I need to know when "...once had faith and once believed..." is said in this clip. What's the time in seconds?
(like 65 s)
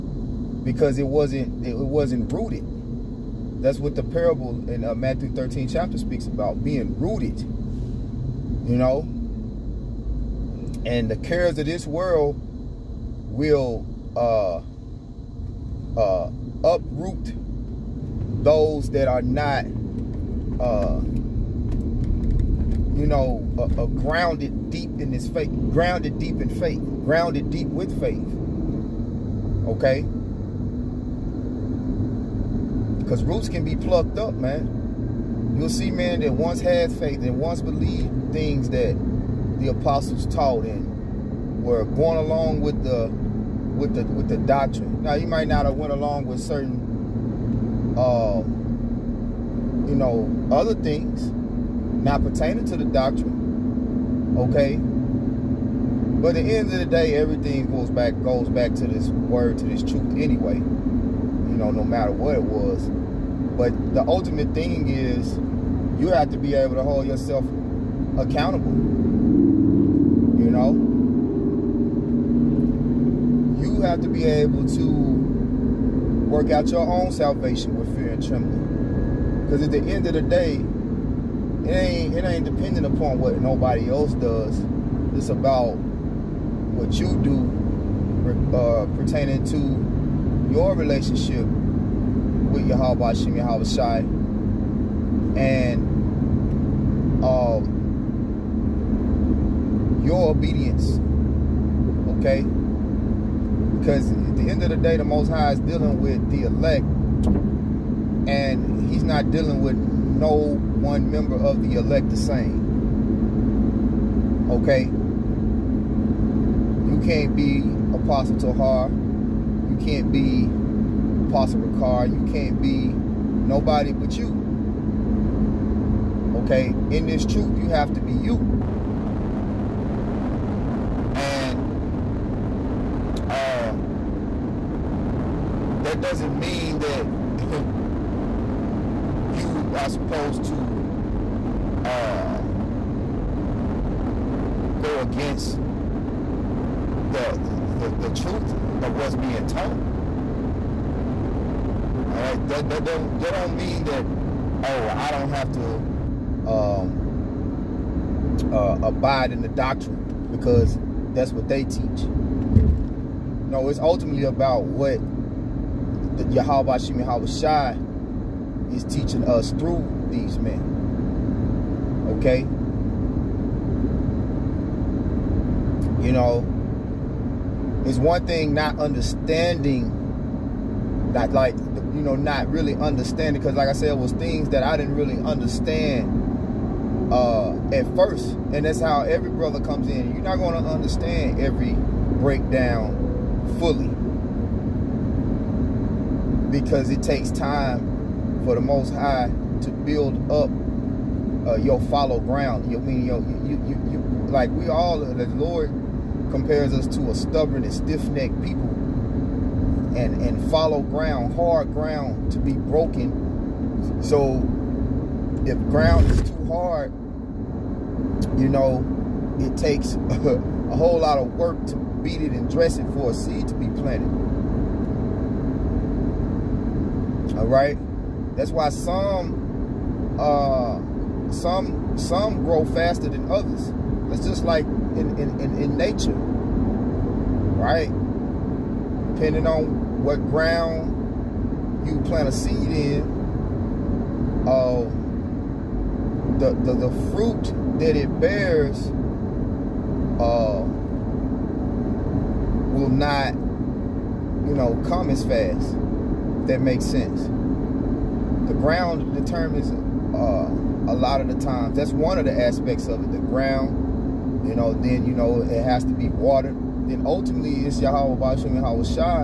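36 s.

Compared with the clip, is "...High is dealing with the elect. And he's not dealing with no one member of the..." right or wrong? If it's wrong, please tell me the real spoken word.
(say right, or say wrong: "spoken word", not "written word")
right.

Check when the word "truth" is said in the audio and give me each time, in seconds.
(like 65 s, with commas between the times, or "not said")
59 s, 127 s, 148 s.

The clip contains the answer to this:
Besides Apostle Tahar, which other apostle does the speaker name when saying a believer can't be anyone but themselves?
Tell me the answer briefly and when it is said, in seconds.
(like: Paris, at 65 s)
Apostle Ricard, at 121 s.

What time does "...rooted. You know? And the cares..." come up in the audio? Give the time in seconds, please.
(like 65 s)
6 s.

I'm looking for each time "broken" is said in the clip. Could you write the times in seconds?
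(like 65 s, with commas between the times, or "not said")
212 s.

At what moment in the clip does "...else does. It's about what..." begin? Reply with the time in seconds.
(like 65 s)
83 s.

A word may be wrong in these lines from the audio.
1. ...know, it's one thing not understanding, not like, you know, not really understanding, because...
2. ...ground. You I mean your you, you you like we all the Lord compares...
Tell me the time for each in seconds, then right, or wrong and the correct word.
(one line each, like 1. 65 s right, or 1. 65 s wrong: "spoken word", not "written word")
1. 176 s right
2. 202 s right.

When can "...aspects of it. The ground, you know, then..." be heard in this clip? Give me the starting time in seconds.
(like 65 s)
262 s.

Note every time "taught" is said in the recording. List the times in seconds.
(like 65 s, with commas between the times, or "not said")
40 s, 149 s.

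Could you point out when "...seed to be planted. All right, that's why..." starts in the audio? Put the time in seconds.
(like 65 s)
223 s.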